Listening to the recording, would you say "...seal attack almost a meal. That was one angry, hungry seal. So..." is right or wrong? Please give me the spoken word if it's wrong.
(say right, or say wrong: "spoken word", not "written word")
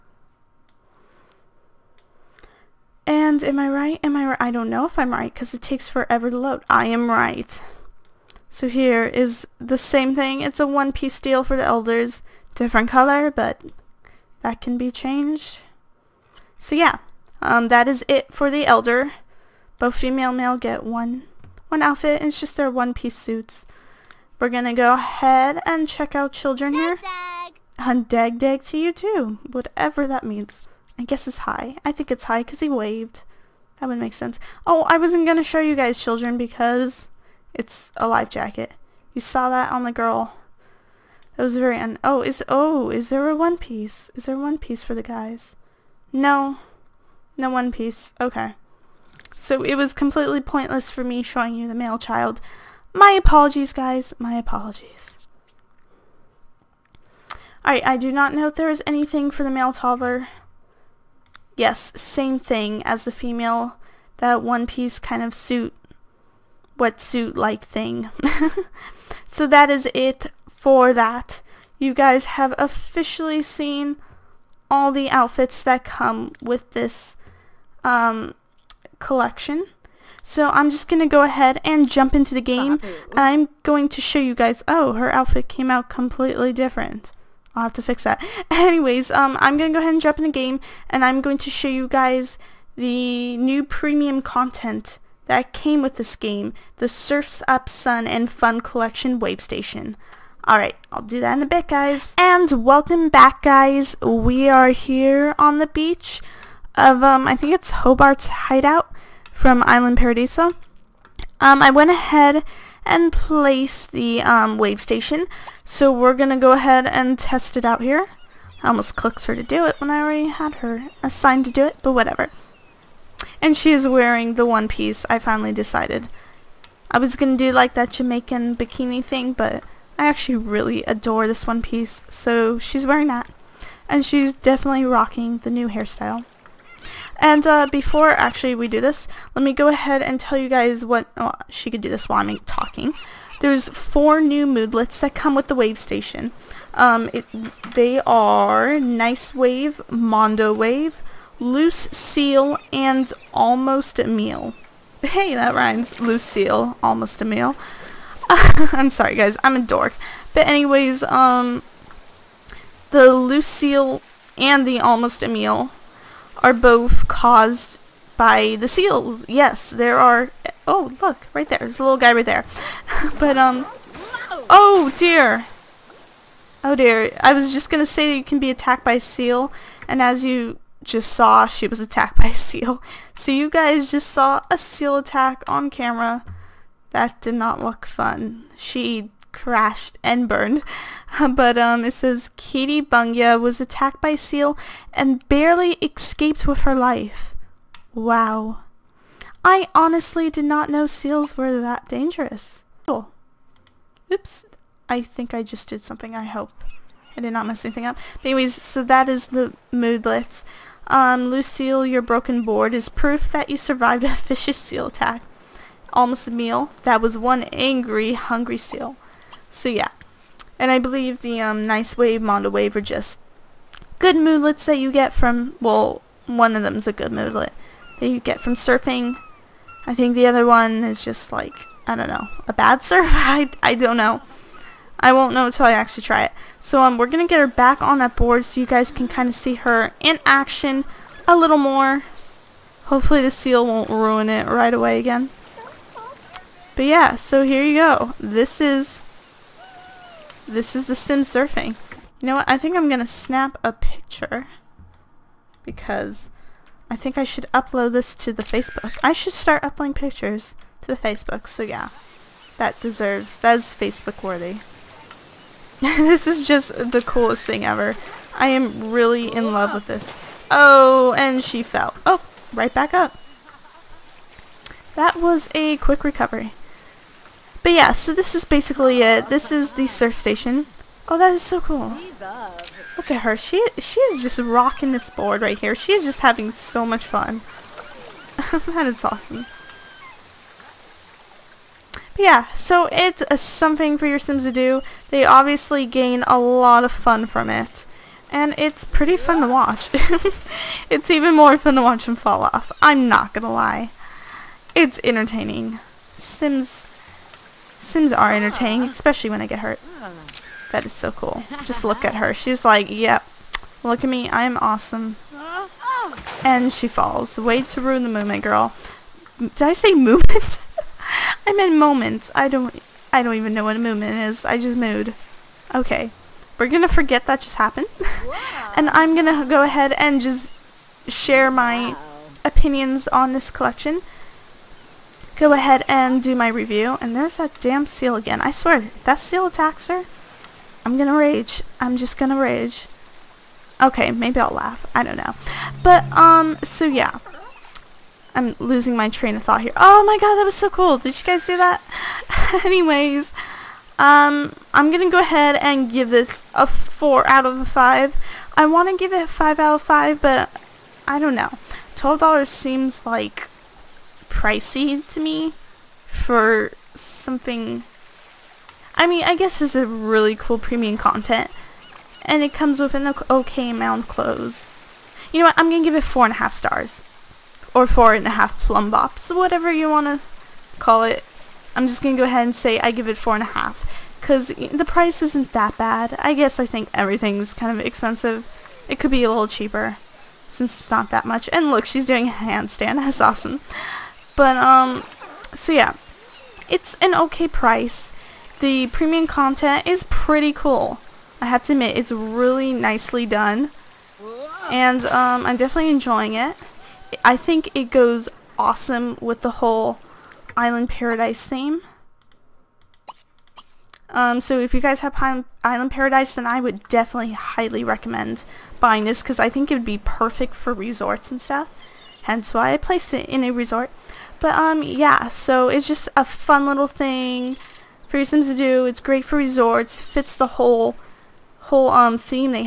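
right.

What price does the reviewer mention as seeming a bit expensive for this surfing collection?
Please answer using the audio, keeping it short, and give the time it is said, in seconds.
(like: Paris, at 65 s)
$12, at 361 s.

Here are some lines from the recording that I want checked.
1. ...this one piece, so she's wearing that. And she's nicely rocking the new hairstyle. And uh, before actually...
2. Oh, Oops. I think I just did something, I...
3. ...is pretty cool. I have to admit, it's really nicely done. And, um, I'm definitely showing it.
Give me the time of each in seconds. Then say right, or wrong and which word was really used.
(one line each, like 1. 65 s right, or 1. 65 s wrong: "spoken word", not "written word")
1. 131 s wrong: "definitely", not "nicely"
2. 202 s right
3. 399 s wrong: "enjoying", not "showing".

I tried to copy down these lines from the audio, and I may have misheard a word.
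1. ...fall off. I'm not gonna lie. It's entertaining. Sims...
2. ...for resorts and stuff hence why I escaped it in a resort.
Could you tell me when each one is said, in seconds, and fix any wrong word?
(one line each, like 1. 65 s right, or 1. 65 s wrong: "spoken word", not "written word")
1. 302 s right
2. 420 s wrong: "placed", not "escaped".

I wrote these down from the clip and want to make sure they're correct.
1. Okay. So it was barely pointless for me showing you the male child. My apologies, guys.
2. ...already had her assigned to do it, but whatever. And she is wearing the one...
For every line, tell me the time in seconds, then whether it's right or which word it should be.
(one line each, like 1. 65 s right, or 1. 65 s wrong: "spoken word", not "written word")
1. 48 s wrong: "completely", not "barely"
2. 120 s right.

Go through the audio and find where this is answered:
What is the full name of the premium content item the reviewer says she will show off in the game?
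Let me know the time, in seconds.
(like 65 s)
96 s.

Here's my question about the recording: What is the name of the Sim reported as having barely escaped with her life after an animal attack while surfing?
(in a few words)
Katie Bungia.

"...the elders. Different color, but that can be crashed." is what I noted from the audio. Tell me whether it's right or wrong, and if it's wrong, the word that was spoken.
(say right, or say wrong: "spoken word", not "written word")
wrong: "changed", not "crashed".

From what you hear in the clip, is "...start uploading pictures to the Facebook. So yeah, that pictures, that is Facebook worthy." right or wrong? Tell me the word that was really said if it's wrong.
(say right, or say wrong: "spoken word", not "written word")
wrong: "deserves", not "pictures".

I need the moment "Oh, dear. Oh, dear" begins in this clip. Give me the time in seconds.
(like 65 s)
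174 s.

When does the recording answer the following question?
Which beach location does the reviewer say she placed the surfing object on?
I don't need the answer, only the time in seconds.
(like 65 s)
107 s.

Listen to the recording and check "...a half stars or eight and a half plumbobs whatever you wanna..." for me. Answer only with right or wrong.
wrong.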